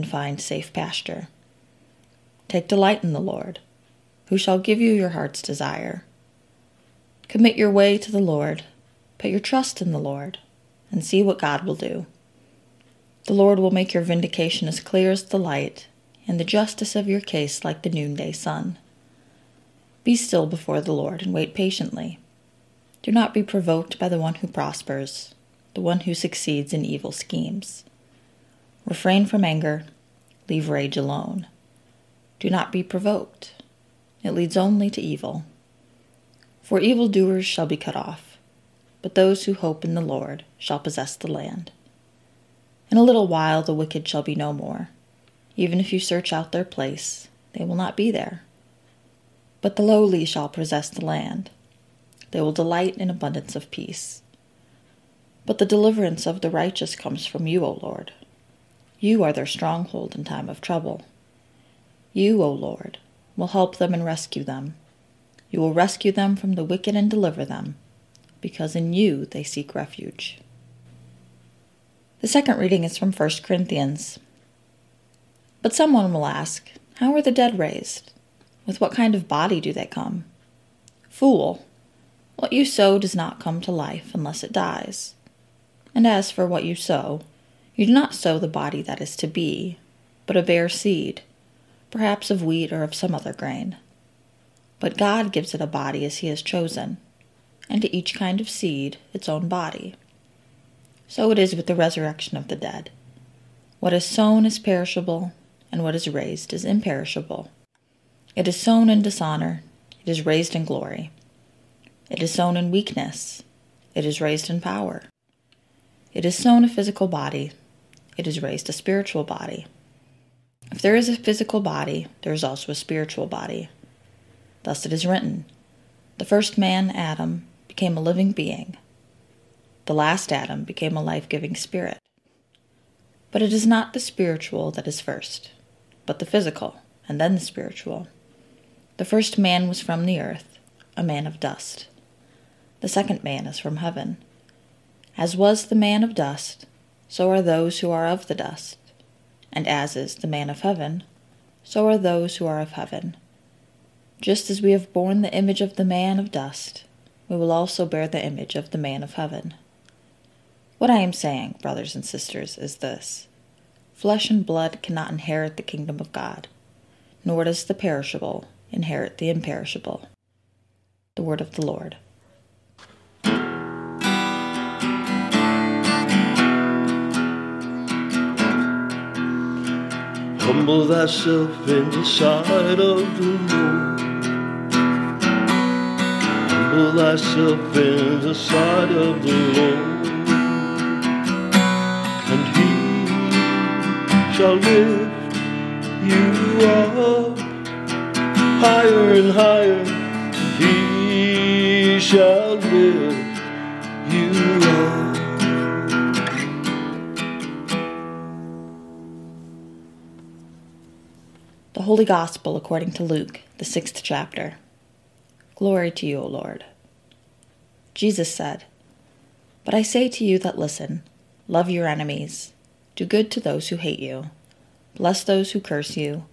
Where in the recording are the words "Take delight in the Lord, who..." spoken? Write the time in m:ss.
0:02.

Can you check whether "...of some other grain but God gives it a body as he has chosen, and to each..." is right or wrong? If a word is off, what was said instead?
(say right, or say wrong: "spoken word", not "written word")
right.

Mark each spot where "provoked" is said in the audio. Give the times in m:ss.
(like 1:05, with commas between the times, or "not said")
0:23, 0:32.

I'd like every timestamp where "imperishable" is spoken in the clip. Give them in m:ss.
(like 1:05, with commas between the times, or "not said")
1:46, 2:49.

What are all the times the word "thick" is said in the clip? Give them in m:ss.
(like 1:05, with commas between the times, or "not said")
not said.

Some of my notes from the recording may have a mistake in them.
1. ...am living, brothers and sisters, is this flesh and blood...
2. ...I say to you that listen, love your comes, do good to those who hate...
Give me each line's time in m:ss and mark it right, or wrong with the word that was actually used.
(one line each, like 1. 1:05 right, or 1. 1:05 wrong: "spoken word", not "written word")
1. 2:41 wrong: "saying", not "living"
2. 3:39 wrong: "enemies", not "comes".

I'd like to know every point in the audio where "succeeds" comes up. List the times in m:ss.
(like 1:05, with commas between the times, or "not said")
0:26.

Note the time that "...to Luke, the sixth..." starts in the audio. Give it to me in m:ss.
3:32.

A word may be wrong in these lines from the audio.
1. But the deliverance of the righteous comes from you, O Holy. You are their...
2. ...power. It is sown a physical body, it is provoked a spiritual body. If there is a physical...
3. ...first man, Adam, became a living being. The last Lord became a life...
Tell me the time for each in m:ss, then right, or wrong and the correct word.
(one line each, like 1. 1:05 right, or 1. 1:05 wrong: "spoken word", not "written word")
1. 0:55 wrong: "Lord", not "Holy"
2. 1:54 wrong: "raised", not "provoked"
3. 2:06 wrong: "Adam", not "Lord".